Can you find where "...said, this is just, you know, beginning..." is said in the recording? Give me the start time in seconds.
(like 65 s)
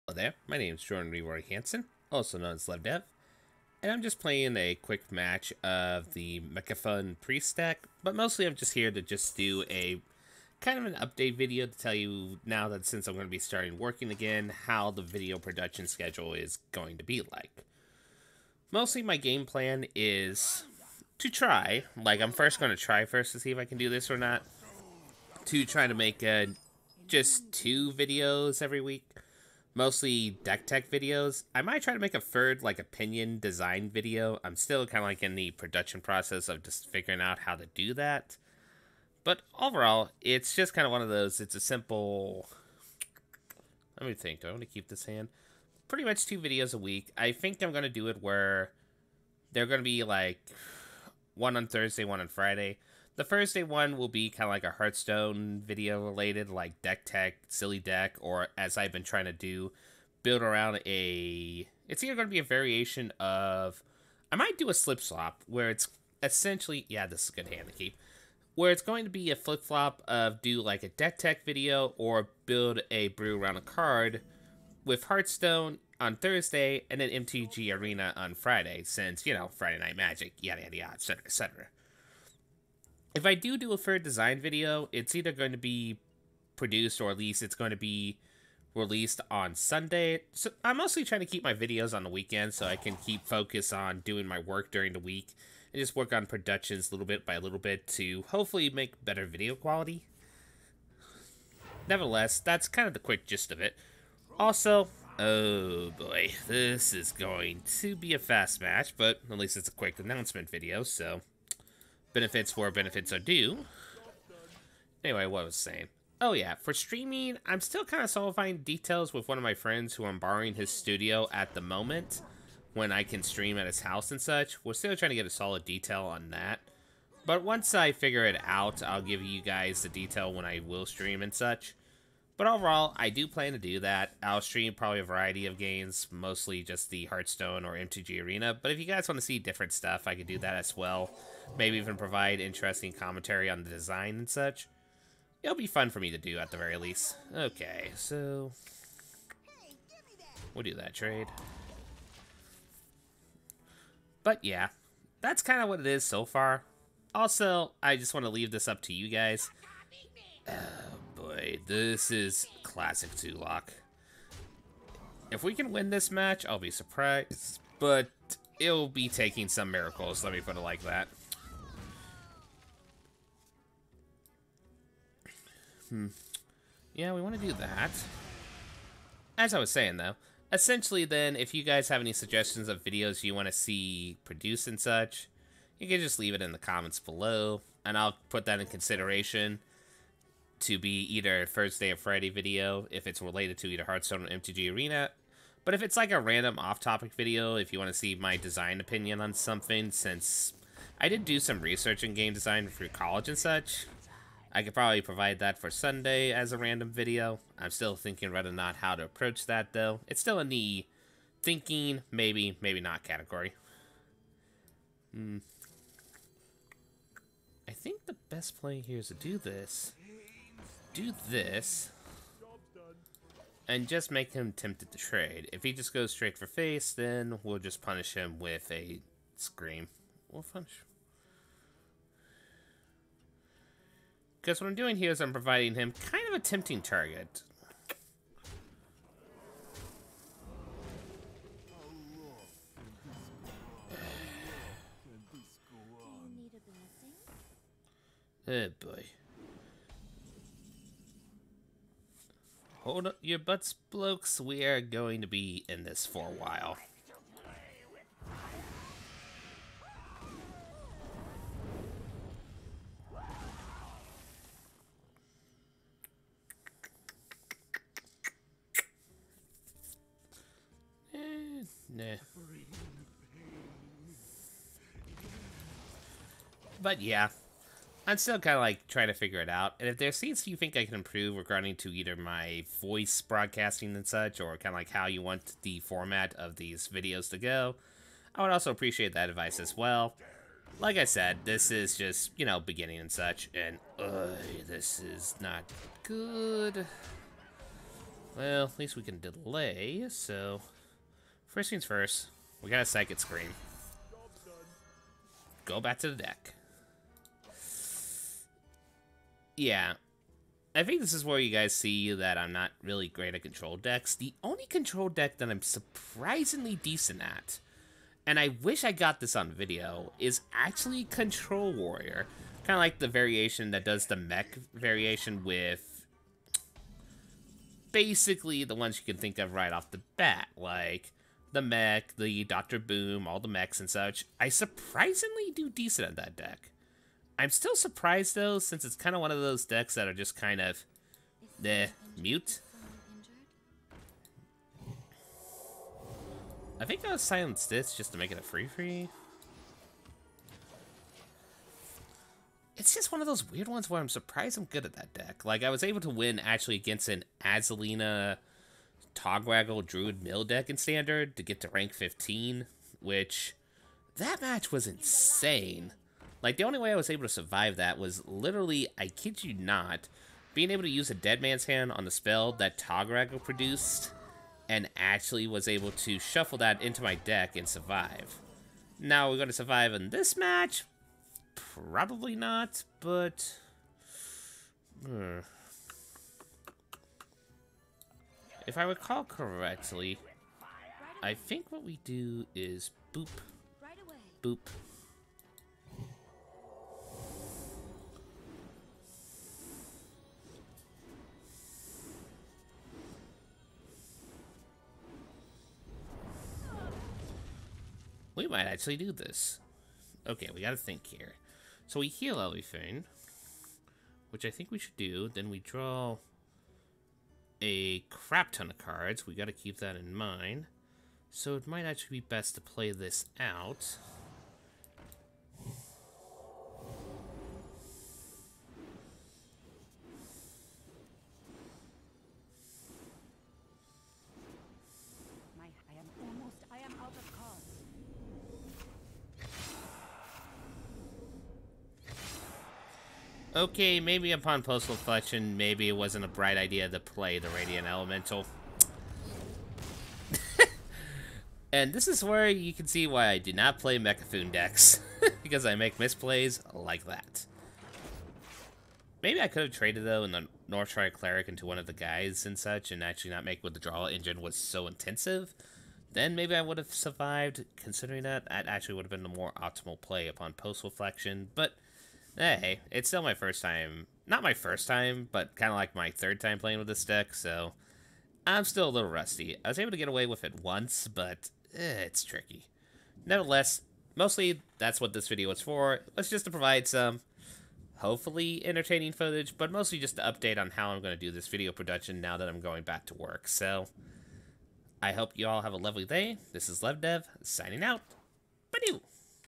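291 s.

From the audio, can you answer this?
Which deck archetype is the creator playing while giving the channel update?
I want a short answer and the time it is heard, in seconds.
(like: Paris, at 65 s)
Mecha'thun Priest, at 6 s.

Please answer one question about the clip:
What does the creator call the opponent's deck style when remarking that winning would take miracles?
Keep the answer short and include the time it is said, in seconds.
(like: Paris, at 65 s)
Zoolock, at 162 s.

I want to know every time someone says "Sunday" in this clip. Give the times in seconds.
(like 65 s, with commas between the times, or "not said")
89 s, 205 s.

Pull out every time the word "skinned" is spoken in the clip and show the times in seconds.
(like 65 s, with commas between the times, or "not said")
not said.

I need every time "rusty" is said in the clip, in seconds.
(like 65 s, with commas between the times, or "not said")
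479 s.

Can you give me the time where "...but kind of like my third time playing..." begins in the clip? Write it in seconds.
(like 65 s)
475 s.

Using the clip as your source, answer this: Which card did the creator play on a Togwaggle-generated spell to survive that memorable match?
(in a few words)
Dead Man's Hand.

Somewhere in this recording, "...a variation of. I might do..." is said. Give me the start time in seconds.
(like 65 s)
62 s.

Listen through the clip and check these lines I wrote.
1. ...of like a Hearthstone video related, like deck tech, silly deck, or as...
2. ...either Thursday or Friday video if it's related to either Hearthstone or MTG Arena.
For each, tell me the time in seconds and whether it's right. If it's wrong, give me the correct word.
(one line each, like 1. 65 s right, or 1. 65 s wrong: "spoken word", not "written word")
1. 54 s right
2. 191 s right.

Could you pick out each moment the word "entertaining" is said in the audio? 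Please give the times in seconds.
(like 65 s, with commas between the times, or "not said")
488 s.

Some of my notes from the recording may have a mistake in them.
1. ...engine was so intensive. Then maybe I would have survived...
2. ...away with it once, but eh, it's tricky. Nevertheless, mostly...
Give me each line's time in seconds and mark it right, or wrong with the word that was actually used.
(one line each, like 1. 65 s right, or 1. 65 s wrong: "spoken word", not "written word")
1. 464 s right
2. 480 s right.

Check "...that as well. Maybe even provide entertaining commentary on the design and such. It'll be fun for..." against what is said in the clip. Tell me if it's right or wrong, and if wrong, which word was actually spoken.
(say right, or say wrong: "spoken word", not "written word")
wrong: "interesting", not "entertaining".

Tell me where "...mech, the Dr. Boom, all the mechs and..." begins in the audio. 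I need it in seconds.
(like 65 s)
331 s.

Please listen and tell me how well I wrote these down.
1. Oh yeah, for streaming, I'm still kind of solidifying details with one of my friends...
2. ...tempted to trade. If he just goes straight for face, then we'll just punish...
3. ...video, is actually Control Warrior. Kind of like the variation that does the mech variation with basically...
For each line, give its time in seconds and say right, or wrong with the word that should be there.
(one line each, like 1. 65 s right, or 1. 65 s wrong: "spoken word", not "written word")
1. 116 s right
2. 224 s right
3. 319 s right.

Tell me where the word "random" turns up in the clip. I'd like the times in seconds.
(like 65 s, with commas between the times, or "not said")
196 s, 206 s.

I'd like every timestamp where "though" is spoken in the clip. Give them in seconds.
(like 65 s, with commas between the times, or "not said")
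179 s, 209 s, 338 s, 460 s.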